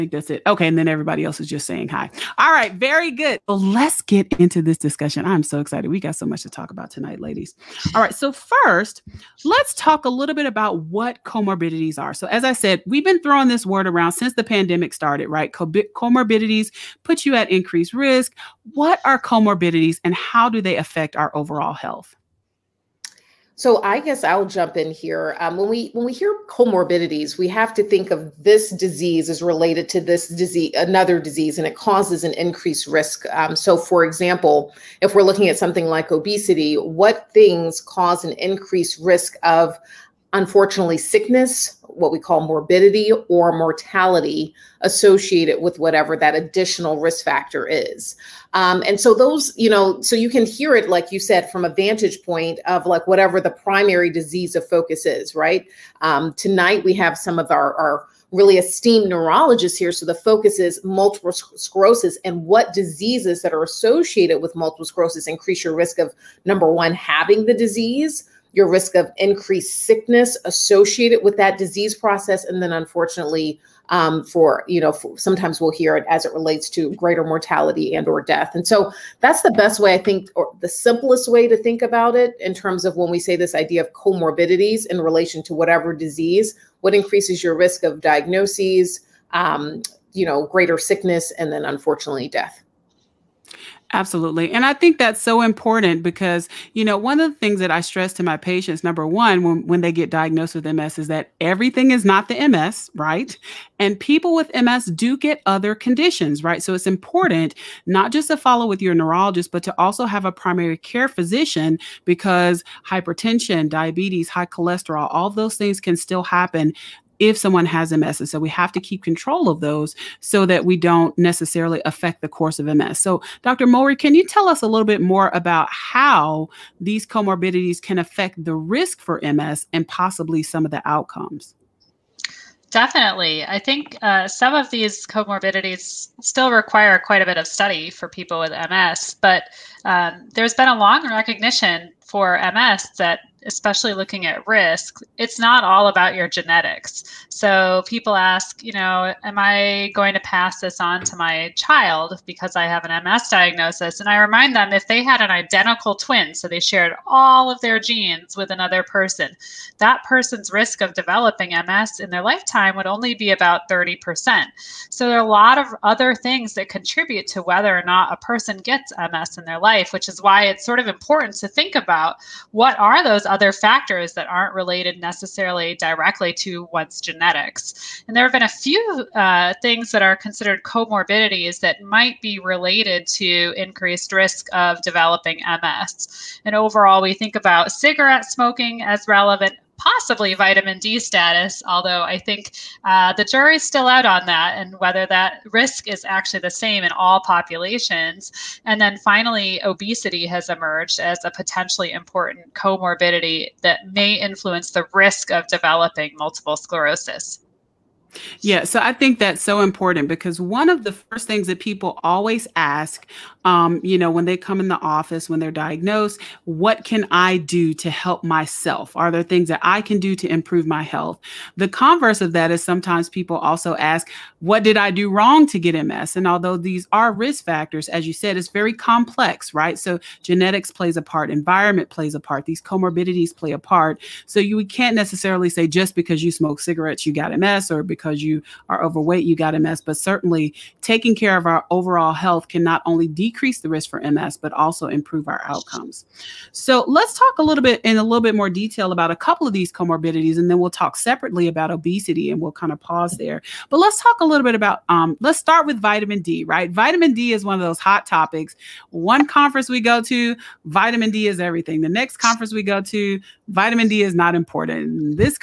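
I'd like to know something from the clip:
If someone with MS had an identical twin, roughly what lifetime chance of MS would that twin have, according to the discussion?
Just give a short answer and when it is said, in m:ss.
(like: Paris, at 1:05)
About 30%, at 2:43.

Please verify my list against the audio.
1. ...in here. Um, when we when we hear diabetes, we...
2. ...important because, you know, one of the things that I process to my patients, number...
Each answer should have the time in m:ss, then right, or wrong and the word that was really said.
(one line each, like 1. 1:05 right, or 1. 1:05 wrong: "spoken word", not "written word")
1. 0:24 wrong: "comorbidities", not "diabetes"
2. 1:35 wrong: "stress", not "process".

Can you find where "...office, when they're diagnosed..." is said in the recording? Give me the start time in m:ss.
3:34.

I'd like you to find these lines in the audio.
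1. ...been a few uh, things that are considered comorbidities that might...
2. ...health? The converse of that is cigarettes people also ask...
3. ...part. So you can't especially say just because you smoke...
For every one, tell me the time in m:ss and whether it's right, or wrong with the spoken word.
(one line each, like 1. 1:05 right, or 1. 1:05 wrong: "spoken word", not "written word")
1. 2:58 right
2. 3:40 wrong: "sometimes", not "cigarettes"
3. 3:53 wrong: "necessarily", not "especially".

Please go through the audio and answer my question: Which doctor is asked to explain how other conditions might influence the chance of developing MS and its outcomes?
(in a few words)
Dr. Mowry.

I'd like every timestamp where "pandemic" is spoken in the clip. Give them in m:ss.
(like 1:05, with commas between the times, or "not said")
0:14.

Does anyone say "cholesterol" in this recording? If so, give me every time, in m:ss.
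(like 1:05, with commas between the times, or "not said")
1:54.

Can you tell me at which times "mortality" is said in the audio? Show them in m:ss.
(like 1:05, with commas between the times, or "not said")
0:43, 1:17.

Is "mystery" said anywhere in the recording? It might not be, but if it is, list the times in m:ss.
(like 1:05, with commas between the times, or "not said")
not said.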